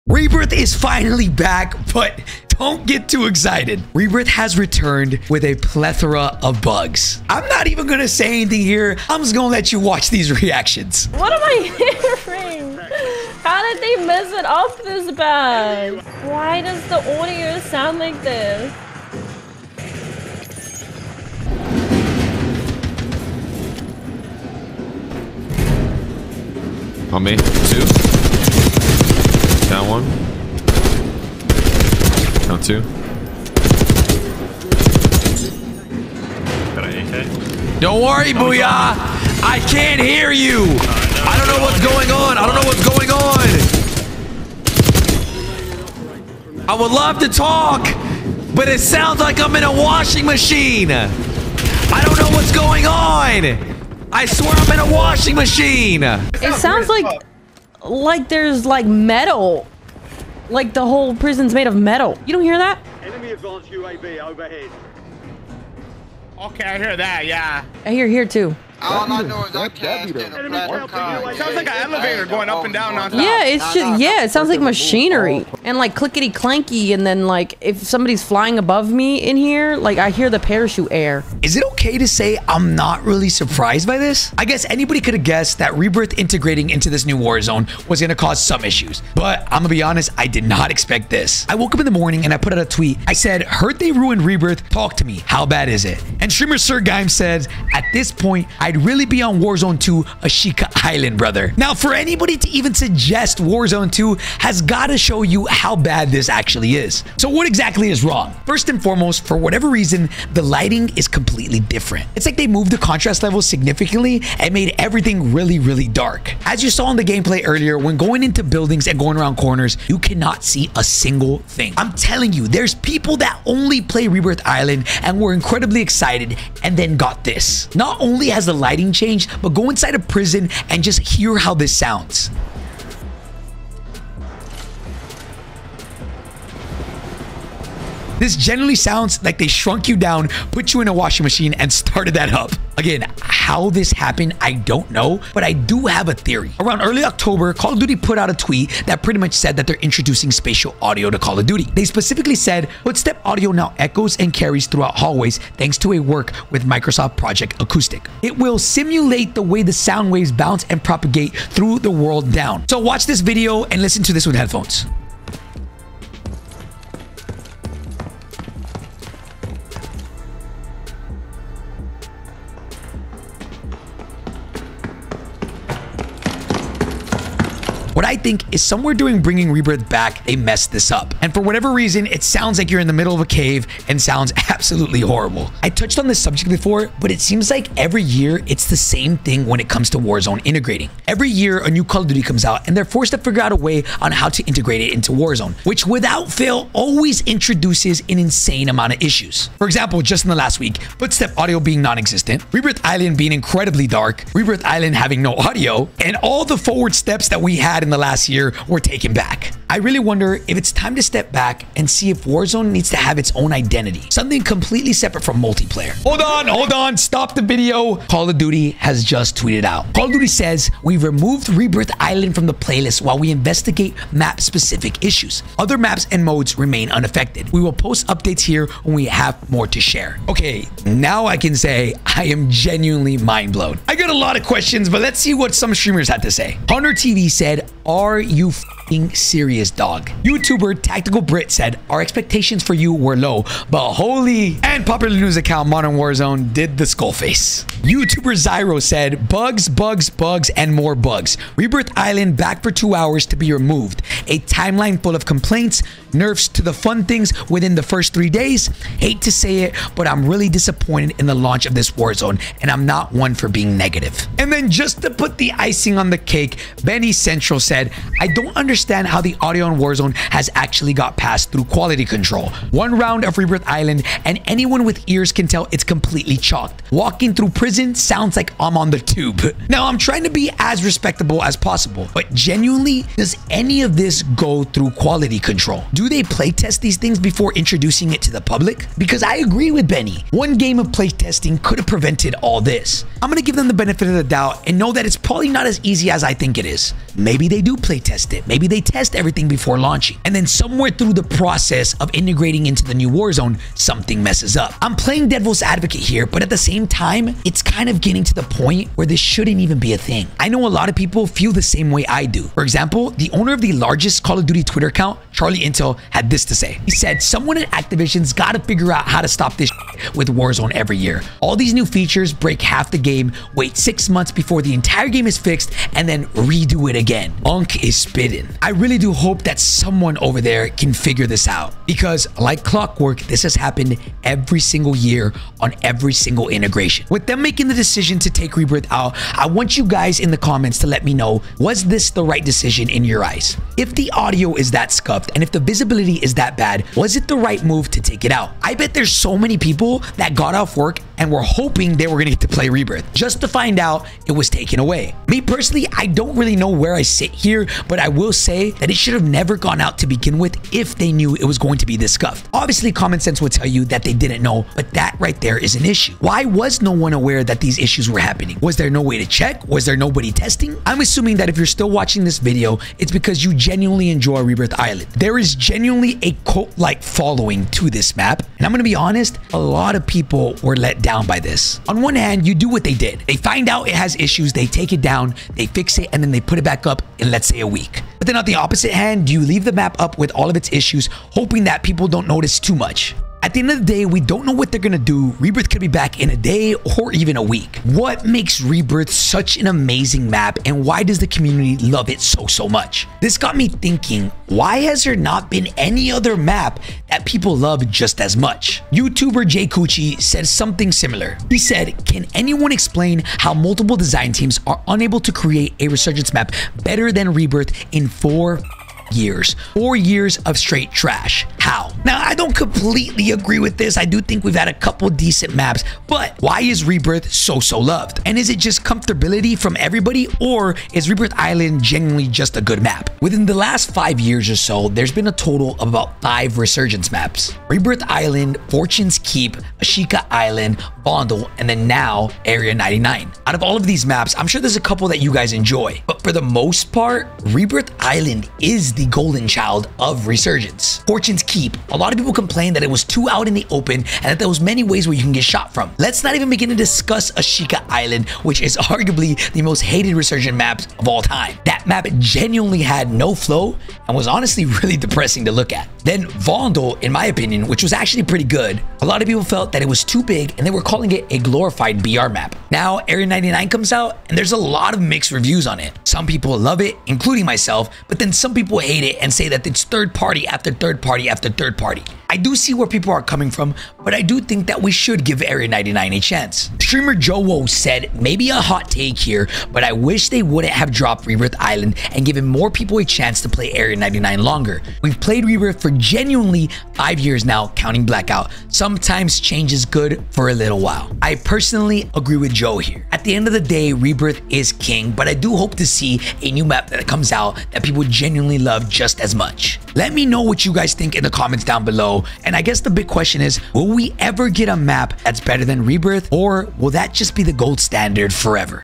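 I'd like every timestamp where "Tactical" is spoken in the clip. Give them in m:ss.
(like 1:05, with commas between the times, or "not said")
4:00.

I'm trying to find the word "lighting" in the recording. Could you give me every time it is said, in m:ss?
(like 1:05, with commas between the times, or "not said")
1:50, 2:08.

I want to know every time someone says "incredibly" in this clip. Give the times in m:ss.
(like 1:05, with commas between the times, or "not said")
2:05, 3:23.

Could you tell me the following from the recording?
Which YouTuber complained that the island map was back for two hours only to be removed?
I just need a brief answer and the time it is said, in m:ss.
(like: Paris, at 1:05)
Zyro, at 4:08.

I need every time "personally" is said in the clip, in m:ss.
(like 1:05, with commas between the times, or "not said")
5:55, 8:21.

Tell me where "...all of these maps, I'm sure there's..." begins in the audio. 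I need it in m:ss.
7:23.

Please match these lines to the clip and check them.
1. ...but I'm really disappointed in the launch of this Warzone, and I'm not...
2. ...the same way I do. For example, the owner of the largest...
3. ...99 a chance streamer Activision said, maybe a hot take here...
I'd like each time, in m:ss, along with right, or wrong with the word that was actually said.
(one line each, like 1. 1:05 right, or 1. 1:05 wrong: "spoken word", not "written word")
1. 4:19 right
2. 5:11 right
3. 8:05 wrong: "Woe", not "Activision".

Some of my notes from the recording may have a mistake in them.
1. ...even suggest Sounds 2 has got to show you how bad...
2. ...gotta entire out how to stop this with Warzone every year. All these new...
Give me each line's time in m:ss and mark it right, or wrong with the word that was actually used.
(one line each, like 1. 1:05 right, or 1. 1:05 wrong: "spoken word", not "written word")
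1. 1:42 wrong: "Warzone", not "Sounds"
2. 5:18 wrong: "figure", not "entire".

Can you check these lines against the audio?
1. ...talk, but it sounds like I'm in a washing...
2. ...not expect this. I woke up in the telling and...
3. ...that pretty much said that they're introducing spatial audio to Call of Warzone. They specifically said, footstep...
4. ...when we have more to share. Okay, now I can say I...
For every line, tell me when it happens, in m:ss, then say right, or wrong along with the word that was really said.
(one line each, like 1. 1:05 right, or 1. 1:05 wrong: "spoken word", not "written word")
1. 0:47 right
2. 1:30 wrong: "morning", not "telling"
3. 2:28 wrong: "Duty", not "Warzone"
4. 3:48 right.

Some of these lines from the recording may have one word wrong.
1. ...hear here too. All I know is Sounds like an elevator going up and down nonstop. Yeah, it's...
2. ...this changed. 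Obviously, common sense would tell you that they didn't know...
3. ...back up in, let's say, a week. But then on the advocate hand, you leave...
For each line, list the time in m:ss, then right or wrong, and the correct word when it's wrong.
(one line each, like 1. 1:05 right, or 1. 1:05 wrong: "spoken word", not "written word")
1. 1:07 right
2. 6:01 wrong: "scuffed", not "changed"
3. 6:26 wrong: "opposite", not "advocate".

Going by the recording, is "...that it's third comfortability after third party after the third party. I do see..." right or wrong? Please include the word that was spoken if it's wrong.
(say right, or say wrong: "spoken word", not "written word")
wrong: "party", not "comfortability".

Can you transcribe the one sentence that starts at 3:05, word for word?
I touched on this subject before, but it seems like every year it's the same thing when it comes to Warzone integrating.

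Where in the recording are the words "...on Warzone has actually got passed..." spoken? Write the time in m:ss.
4:29.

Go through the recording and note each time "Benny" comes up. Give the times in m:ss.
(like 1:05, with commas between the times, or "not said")
4:26, 4:49.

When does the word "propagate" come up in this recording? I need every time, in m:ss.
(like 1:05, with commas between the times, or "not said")
2:40.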